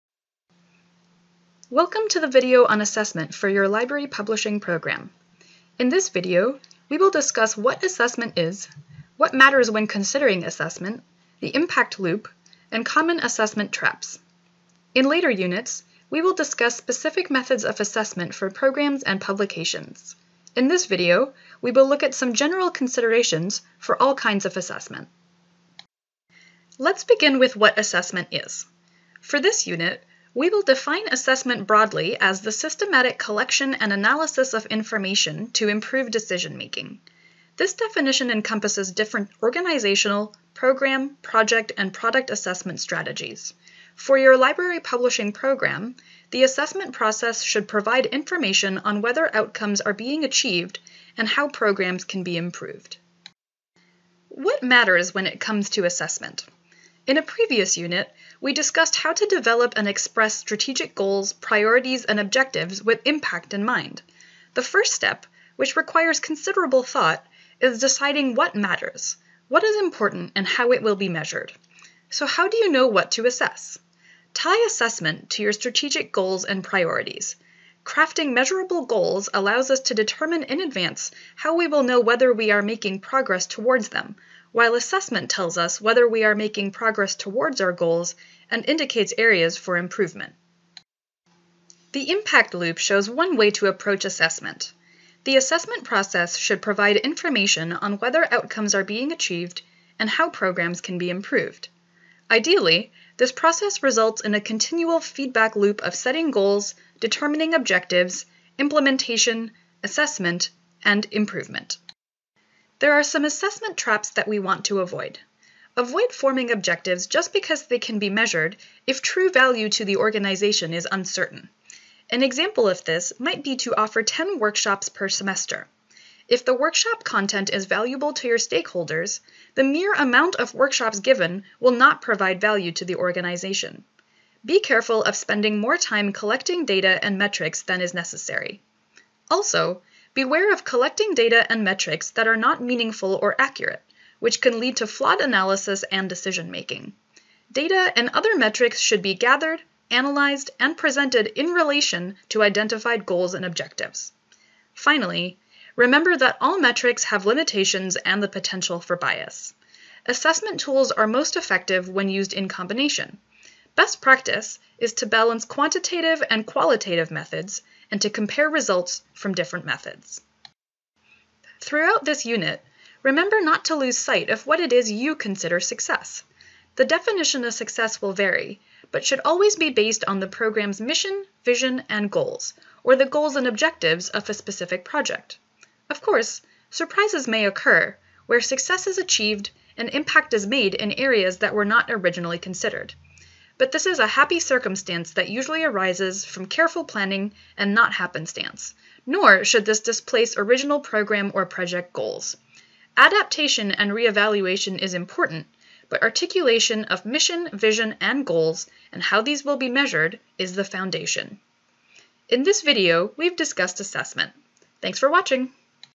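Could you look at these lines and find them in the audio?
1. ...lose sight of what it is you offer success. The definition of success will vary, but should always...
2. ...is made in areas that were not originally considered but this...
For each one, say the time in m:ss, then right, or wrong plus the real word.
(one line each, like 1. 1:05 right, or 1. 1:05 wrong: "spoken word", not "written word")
1. 2:53 wrong: "consider", not "offer"
2. 3:10 right.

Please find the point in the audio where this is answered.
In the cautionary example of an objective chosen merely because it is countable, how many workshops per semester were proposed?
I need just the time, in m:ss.
2:04.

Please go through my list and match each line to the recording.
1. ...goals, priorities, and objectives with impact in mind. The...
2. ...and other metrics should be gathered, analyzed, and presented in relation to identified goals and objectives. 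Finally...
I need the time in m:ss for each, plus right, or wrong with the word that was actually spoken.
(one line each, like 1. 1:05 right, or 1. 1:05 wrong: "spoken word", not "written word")
1. 1:00 right
2. 2:27 right.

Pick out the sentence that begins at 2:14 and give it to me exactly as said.
Be careful of spending more time collecting data and metrics than is necessary.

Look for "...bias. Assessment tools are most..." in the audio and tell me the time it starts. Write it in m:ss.
2:38.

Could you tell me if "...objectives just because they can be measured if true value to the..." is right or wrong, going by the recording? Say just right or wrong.
right.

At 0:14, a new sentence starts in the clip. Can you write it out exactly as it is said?
In later units, we will discuss specific methods of assessment for programs and publications.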